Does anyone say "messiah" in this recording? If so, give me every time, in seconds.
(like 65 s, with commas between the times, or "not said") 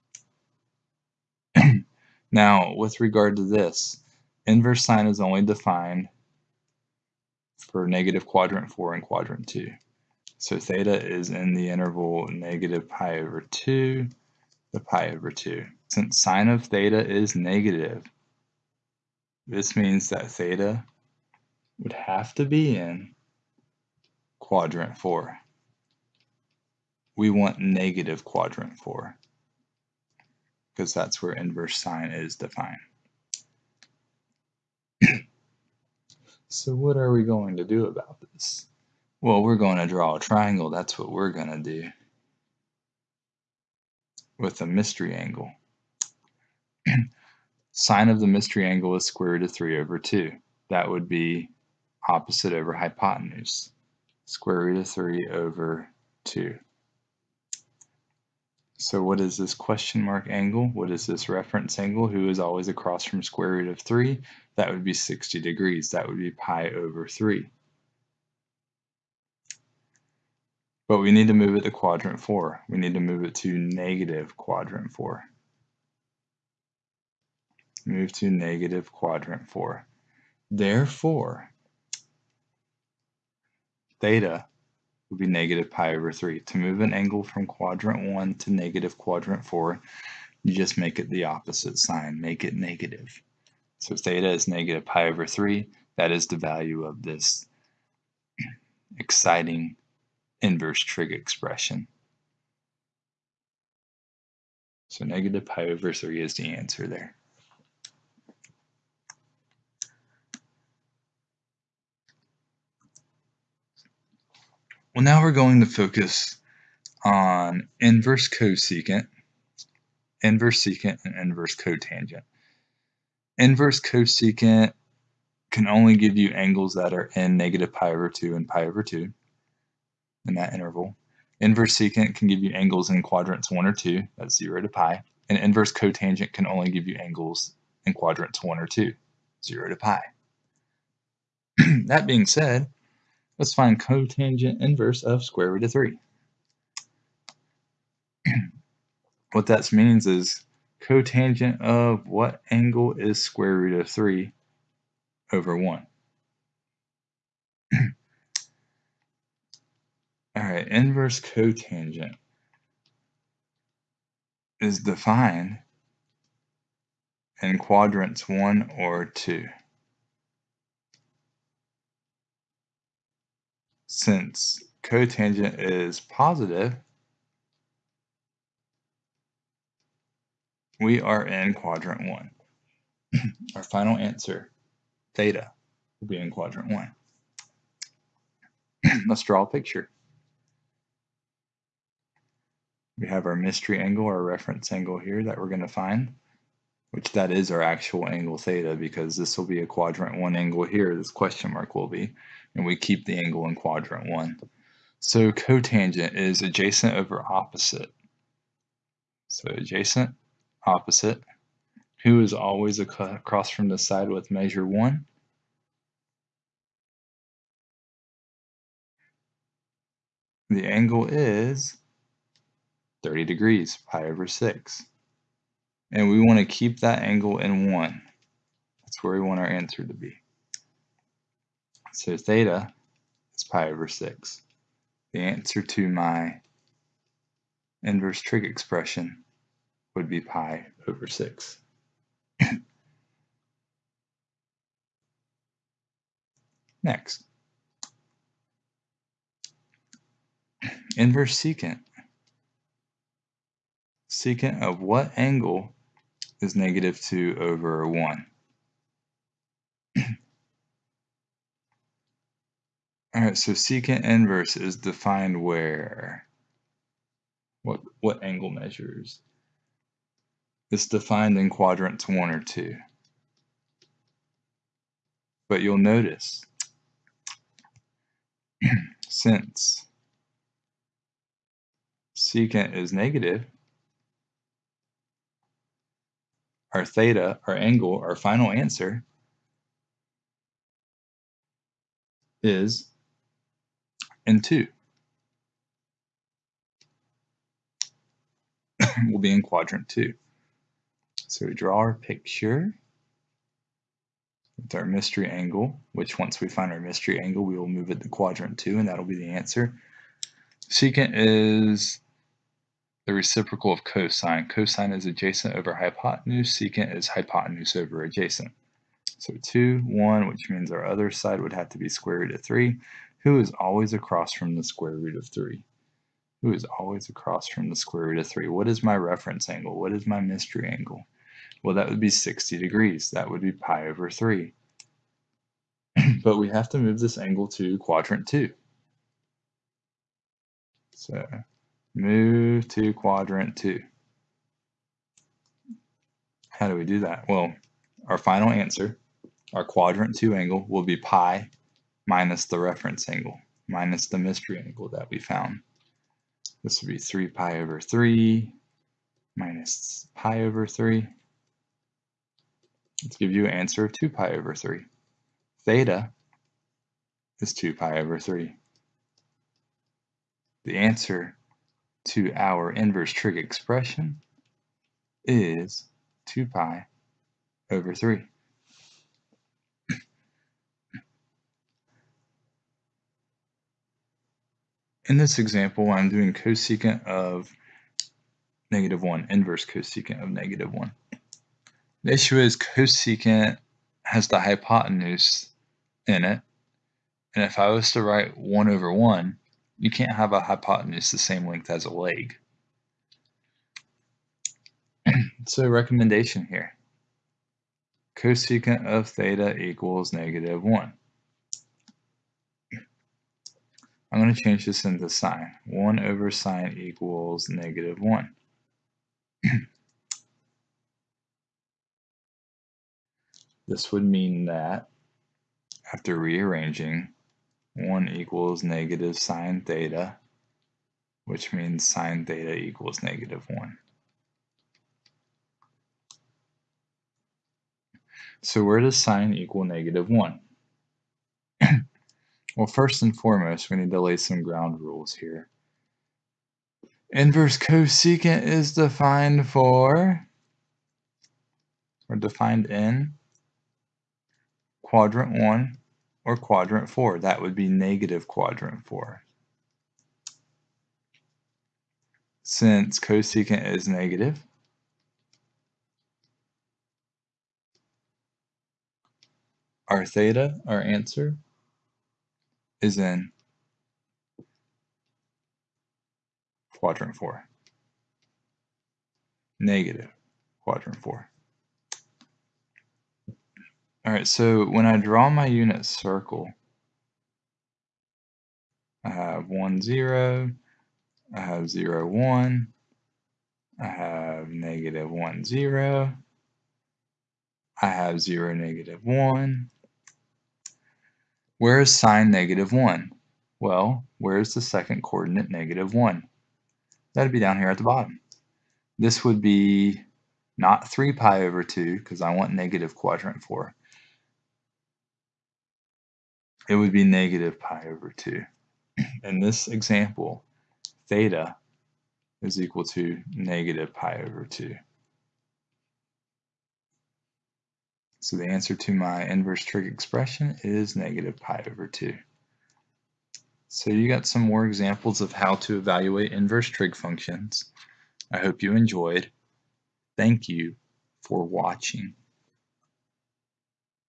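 not said.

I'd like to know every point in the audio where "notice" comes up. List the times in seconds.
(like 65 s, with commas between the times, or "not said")
275 s.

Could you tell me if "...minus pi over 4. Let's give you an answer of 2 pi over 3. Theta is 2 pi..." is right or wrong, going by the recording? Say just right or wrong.
wrong.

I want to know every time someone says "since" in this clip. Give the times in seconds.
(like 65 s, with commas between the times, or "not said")
15 s, 173 s, 279 s, 462 s.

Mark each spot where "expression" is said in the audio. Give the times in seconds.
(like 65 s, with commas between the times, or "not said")
101 s, 238 s, 373 s, 529 s.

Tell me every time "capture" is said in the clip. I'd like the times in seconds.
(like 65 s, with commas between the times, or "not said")
not said.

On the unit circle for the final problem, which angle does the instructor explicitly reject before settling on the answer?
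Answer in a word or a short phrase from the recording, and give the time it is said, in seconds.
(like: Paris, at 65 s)
3π/2, at 510 s.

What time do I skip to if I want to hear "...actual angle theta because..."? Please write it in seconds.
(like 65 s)
197 s.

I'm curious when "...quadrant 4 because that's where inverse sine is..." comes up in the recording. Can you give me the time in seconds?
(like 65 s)
28 s.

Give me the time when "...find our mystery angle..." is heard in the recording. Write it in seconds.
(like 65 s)
306 s.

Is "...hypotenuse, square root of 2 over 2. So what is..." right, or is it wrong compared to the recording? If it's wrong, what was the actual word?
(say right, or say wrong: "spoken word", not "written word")
wrong: "3", not "2".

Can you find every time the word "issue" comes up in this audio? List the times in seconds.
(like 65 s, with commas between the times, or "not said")
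392 s.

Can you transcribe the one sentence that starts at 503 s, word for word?
Well, where is the second coordinate negative 1?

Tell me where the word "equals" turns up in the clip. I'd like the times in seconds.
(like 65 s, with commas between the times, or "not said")
409 s, 416 s, 428 s, 432 s, 439 s, 522 s.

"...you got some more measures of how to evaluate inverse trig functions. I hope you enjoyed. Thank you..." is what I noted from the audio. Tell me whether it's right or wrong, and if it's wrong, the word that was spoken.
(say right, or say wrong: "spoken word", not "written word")
wrong: "examples", not "measures".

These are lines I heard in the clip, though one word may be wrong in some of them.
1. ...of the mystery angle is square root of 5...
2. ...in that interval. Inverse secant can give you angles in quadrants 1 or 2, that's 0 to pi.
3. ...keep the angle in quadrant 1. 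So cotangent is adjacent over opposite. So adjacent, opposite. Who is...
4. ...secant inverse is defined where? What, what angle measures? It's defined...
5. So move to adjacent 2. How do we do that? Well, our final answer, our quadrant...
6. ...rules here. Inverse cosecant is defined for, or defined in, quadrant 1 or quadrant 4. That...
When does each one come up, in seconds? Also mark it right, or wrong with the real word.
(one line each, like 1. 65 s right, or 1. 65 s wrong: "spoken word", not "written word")
1. 48 s wrong: "3", not "5"
2. 130 s right
3. 202 s right
4. 263 s right
5. 340 s wrong: "quadrant", not "adjacent"
6. 444 s right.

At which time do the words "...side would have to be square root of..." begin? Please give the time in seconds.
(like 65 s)
321 s.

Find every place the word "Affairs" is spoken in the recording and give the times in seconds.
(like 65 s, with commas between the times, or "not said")
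not said.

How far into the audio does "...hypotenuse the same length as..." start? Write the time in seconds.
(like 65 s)
400 s.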